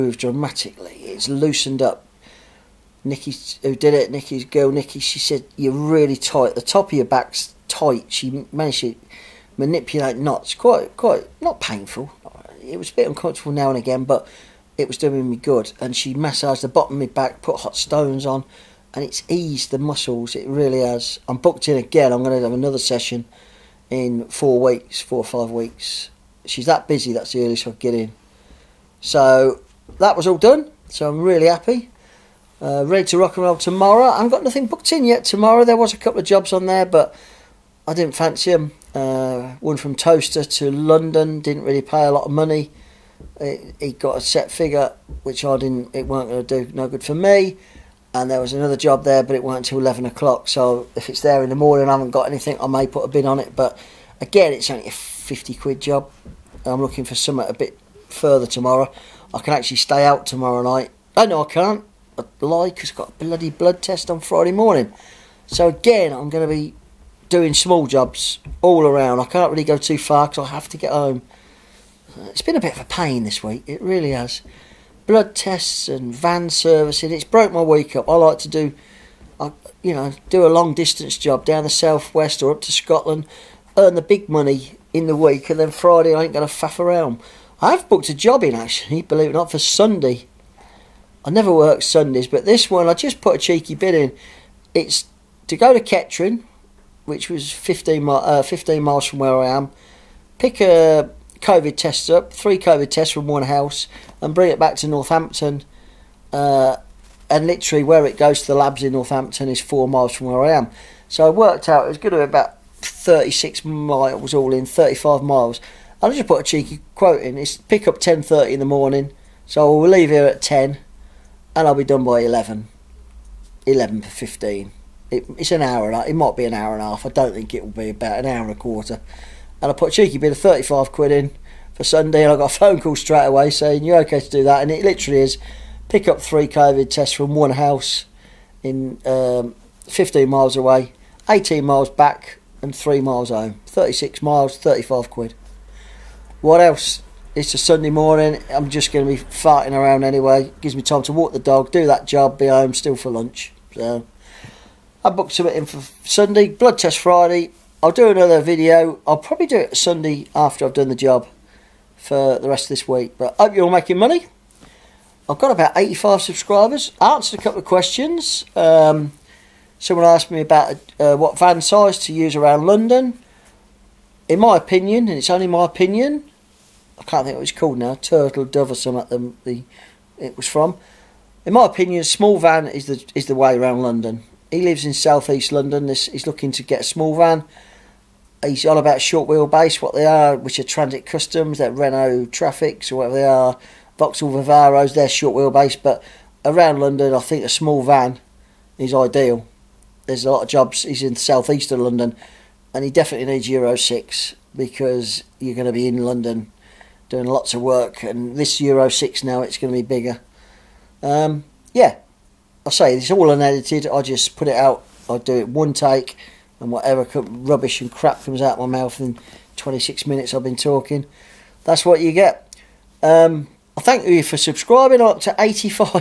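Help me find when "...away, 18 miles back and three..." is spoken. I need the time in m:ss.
2:20.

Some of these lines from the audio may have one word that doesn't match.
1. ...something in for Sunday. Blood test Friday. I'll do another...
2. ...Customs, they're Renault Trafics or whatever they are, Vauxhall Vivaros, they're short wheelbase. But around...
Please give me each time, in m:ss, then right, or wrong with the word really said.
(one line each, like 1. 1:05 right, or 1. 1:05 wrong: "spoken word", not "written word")
1. 2:35 right
2. 3:11 right.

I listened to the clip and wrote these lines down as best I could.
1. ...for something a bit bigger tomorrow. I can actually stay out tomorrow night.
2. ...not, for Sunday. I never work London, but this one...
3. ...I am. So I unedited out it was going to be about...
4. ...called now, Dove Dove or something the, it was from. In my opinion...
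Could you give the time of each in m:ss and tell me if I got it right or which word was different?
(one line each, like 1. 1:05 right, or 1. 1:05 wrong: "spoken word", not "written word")
1. 0:57 wrong: "further", not "bigger"
2. 1:29 wrong: "Sundays", not "London"
3. 1:50 wrong: "worked", not "unedited"
4. 2:57 wrong: "Turtle", not "Dove".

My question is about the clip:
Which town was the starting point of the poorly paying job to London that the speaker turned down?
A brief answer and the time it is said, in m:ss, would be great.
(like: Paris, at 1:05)
Towcester, at 0:39.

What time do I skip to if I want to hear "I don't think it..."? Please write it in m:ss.
2:07.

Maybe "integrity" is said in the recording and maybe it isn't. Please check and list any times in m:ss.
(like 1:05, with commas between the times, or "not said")
not said.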